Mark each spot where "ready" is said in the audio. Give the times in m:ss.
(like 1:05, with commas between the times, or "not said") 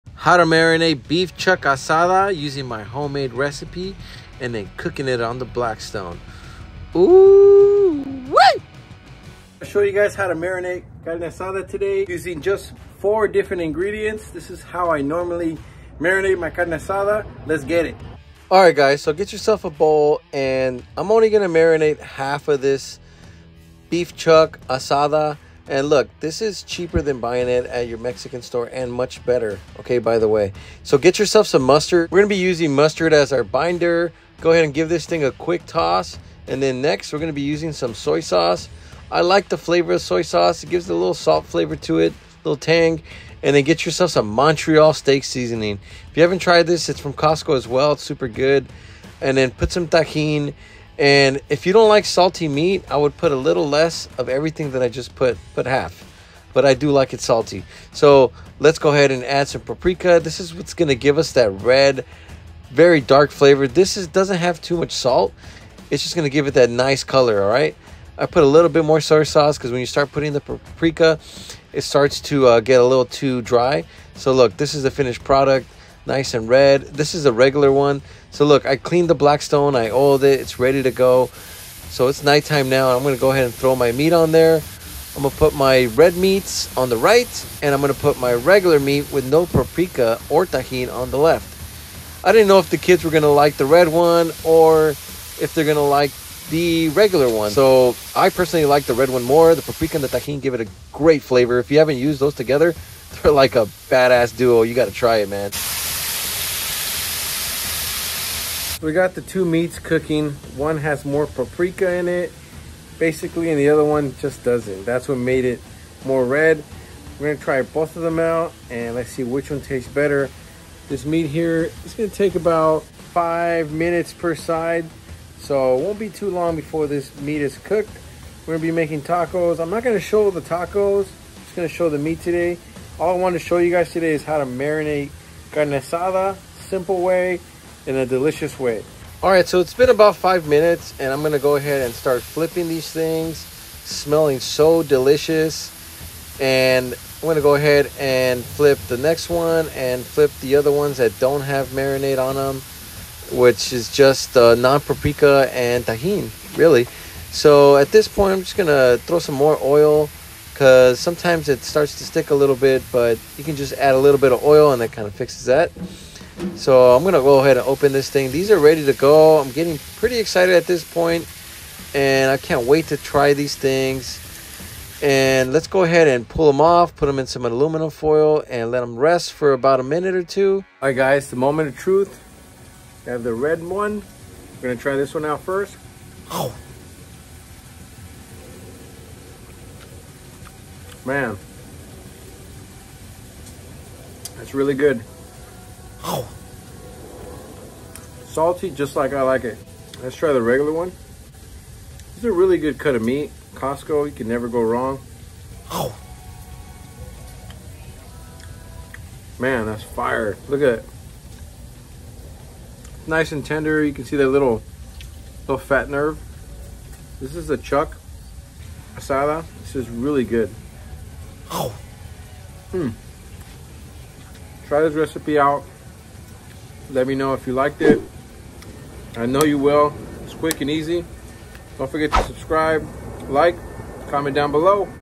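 1:20, 2:48.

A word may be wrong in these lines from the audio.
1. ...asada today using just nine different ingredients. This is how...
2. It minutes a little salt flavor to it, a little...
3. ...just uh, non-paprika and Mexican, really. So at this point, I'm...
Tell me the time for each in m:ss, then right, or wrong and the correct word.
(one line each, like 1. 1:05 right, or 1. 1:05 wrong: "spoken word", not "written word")
1. 0:11 wrong: "four", not "nine"
2. 0:40 wrong: "gives", not "minutes"
3. 2:33 wrong: "Tajin", not "Mexican".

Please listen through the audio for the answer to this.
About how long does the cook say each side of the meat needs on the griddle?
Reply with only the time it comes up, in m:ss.
2:02.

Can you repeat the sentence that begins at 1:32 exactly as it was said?
I didn't know if the kids were gonna like the red one or if they're gonna like the regular one.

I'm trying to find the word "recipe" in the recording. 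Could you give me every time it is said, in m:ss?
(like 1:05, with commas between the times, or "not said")
0:03, 3:44.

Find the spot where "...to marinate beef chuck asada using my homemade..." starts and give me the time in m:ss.
0:00.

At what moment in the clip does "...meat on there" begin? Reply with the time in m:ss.
1:23.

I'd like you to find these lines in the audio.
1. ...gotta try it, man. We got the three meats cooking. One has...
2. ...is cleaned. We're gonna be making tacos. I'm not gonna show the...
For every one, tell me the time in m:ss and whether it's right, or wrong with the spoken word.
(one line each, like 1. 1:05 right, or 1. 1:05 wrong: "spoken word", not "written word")
1. 1:44 wrong: "two", not "three"
2. 2:07 wrong: "cooked", not "cleaned".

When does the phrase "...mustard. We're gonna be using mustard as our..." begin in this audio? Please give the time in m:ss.
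0:31.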